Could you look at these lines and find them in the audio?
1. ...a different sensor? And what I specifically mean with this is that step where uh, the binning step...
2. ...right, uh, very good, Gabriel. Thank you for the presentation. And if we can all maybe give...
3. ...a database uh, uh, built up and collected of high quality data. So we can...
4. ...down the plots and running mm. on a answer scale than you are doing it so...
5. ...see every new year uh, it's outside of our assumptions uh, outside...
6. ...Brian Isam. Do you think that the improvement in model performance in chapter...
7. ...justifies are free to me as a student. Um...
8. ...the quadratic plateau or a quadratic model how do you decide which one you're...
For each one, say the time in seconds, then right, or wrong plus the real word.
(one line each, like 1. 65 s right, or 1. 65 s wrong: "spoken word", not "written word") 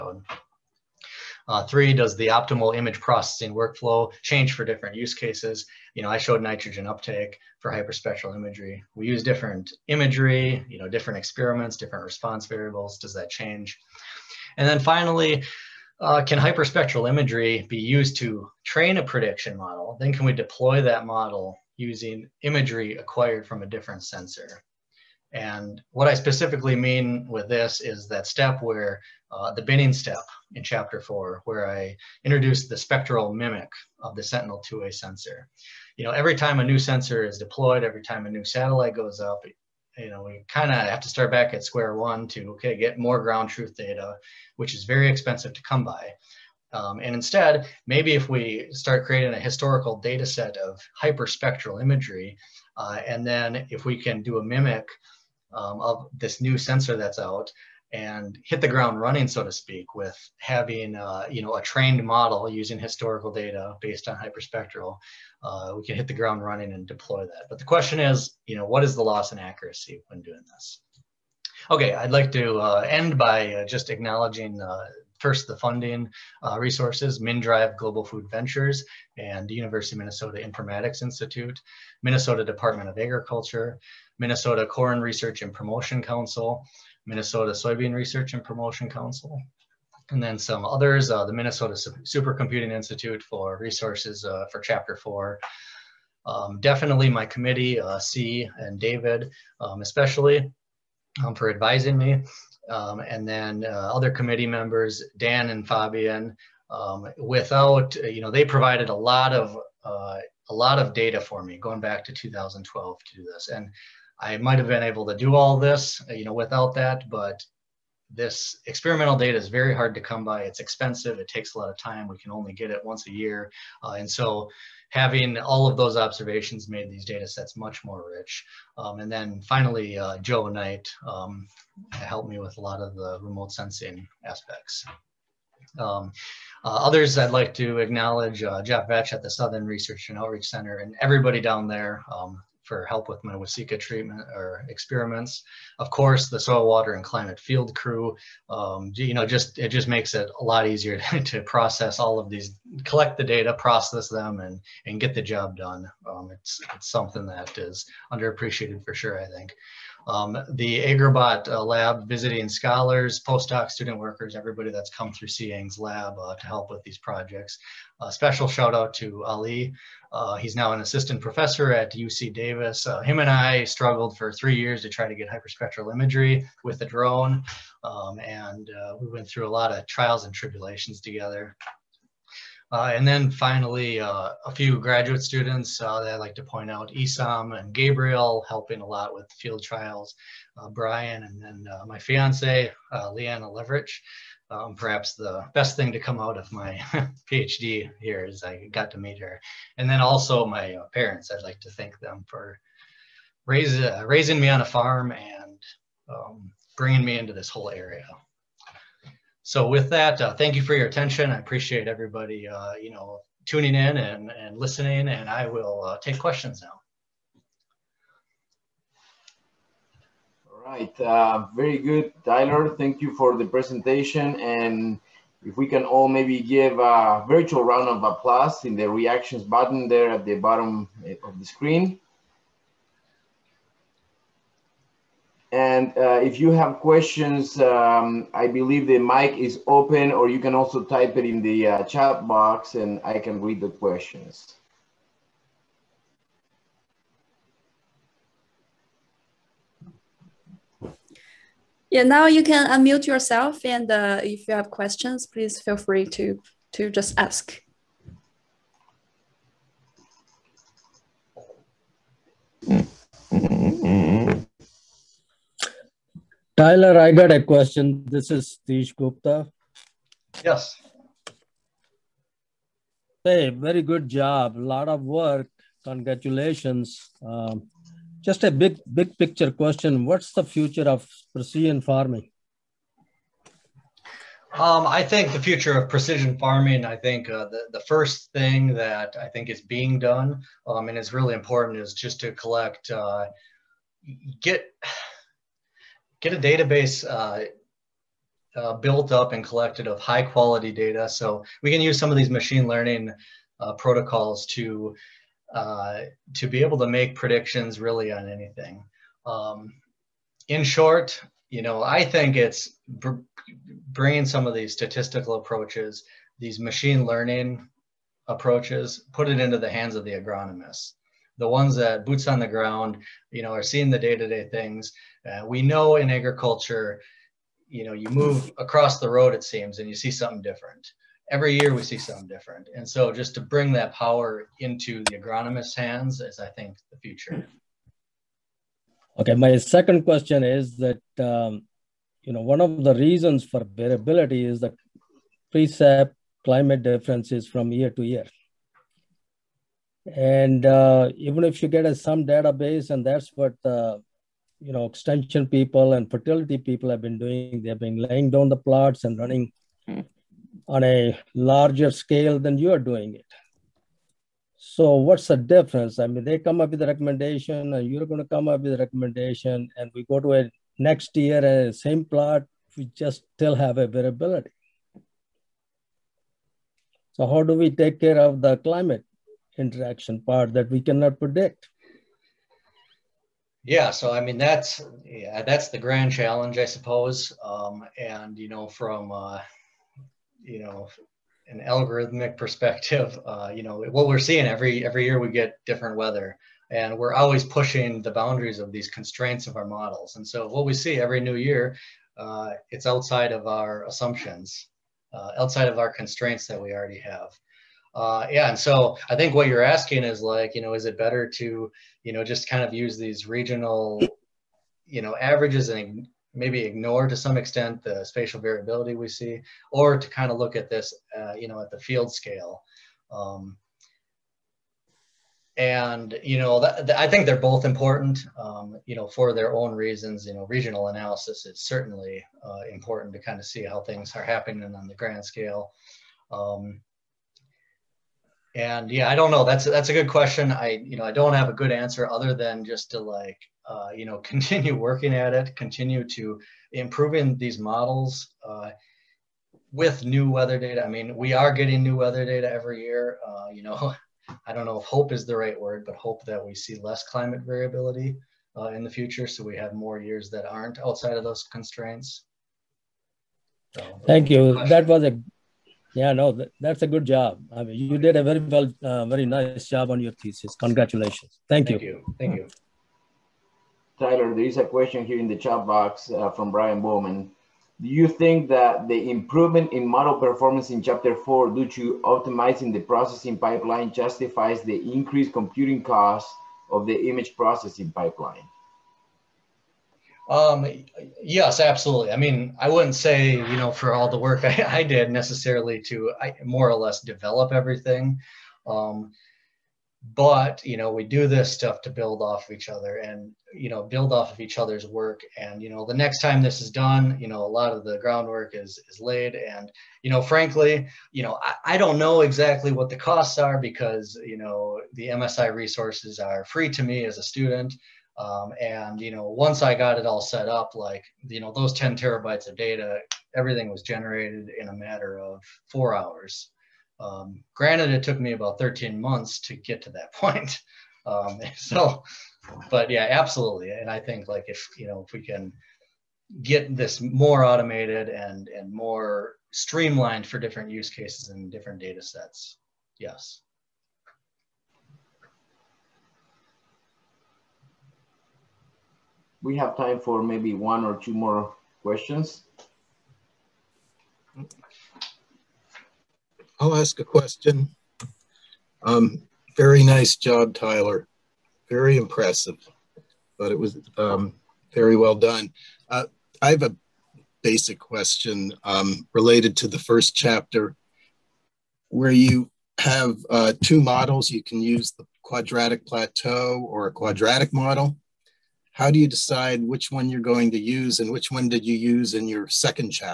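1. 23 s right
2. 220 s wrong: "Tyler", not "Gabriel"
3. 296 s right
4. 358 s wrong: "larger", not "answer"
5. 400 s right
6. 476 s wrong: "Bowman", not "Isam"
7. 515 s wrong: "resources", not "justifies"
8. 574 s right.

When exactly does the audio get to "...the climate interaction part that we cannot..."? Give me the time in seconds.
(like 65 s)
378 s.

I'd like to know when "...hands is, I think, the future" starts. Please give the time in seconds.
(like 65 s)
335 s.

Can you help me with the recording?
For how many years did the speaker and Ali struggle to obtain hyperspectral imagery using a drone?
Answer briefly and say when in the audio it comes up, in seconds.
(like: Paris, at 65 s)
3 years, at 174 s.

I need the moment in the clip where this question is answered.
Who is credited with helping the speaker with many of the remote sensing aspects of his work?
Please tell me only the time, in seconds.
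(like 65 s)
130 s.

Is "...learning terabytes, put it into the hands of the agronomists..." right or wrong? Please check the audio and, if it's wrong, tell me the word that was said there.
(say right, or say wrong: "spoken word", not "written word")
wrong: "approaches", not "terabytes".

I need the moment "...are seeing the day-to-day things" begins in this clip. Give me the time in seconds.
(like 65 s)
323 s.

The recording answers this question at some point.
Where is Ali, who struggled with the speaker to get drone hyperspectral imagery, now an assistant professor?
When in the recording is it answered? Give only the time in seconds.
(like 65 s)
171 s.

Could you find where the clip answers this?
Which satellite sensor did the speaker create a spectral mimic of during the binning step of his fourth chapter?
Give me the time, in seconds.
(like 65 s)
34 s.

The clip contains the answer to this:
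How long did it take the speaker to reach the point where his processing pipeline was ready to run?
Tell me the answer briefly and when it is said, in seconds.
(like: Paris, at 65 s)
13 months, at 528 s.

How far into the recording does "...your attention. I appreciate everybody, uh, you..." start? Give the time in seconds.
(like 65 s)
210 s.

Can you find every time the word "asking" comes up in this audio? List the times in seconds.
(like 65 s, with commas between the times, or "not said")
409 s.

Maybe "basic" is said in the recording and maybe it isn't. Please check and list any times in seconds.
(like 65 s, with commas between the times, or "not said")
567 s.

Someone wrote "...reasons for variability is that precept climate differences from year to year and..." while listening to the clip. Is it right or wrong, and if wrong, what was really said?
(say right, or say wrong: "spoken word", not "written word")
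right.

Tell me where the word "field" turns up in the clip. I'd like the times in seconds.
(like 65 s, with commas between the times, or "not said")
147 s, 189 s, 421 s.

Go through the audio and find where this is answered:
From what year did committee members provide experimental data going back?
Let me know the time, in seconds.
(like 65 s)
112 s.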